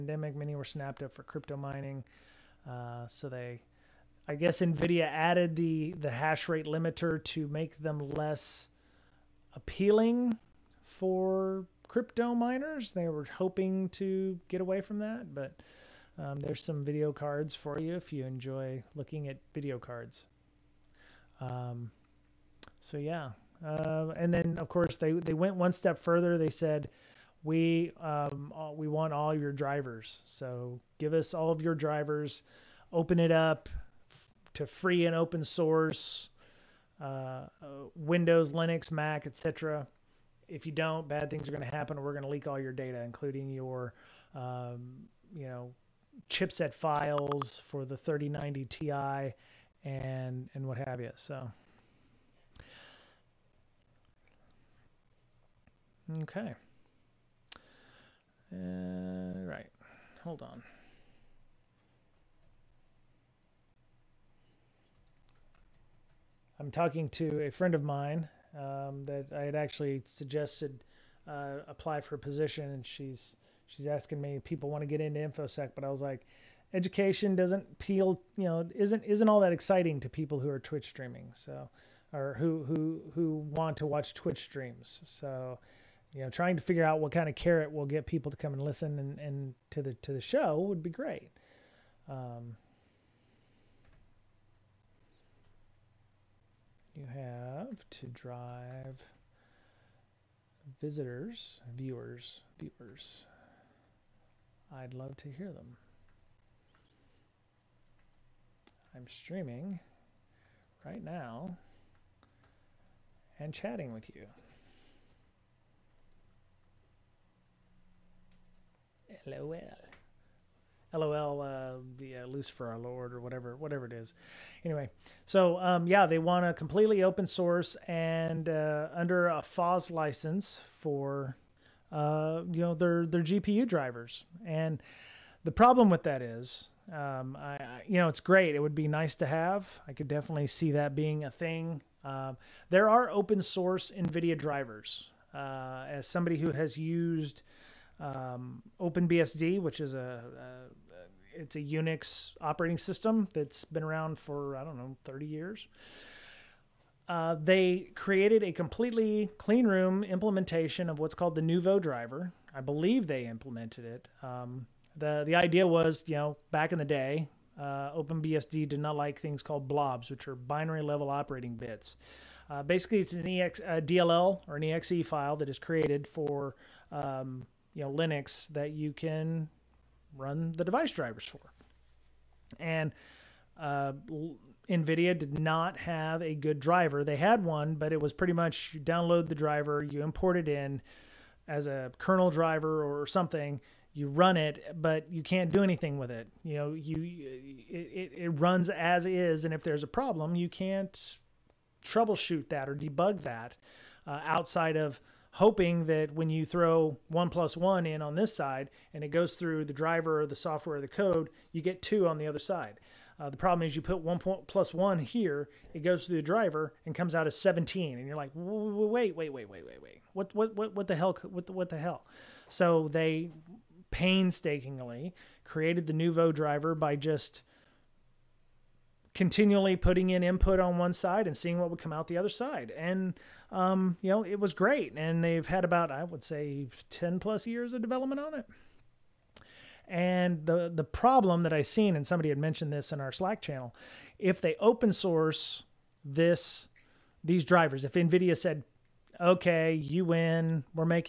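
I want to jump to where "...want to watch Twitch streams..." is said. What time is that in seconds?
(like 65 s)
83 s.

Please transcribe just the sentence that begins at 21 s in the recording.
Um, so yeah, uh, and then, of course, they, they went one step further.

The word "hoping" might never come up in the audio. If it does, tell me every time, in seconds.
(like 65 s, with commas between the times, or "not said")
13 s, 205 s.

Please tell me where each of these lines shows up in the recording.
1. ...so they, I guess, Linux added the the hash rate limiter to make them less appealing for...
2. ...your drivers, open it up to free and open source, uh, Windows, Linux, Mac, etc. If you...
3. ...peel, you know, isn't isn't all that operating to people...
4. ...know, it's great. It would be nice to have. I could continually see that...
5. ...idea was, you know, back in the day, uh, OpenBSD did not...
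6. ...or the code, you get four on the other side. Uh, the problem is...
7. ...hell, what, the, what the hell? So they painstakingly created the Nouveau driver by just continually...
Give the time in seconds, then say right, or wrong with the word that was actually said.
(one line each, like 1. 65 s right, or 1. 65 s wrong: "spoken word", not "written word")
1. 3 s wrong: "Nvidia", not "Linux"
2. 31 s right
3. 77 s wrong: "exciting", not "operating"
4. 137 s wrong: "definitely", not "continually"
5. 165 s right
6. 210 s wrong: "two", not "four"
7. 220 s right.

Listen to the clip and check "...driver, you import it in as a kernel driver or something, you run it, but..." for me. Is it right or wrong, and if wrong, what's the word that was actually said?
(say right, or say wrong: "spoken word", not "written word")
right.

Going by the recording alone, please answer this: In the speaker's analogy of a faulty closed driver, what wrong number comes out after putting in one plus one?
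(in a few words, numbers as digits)
17.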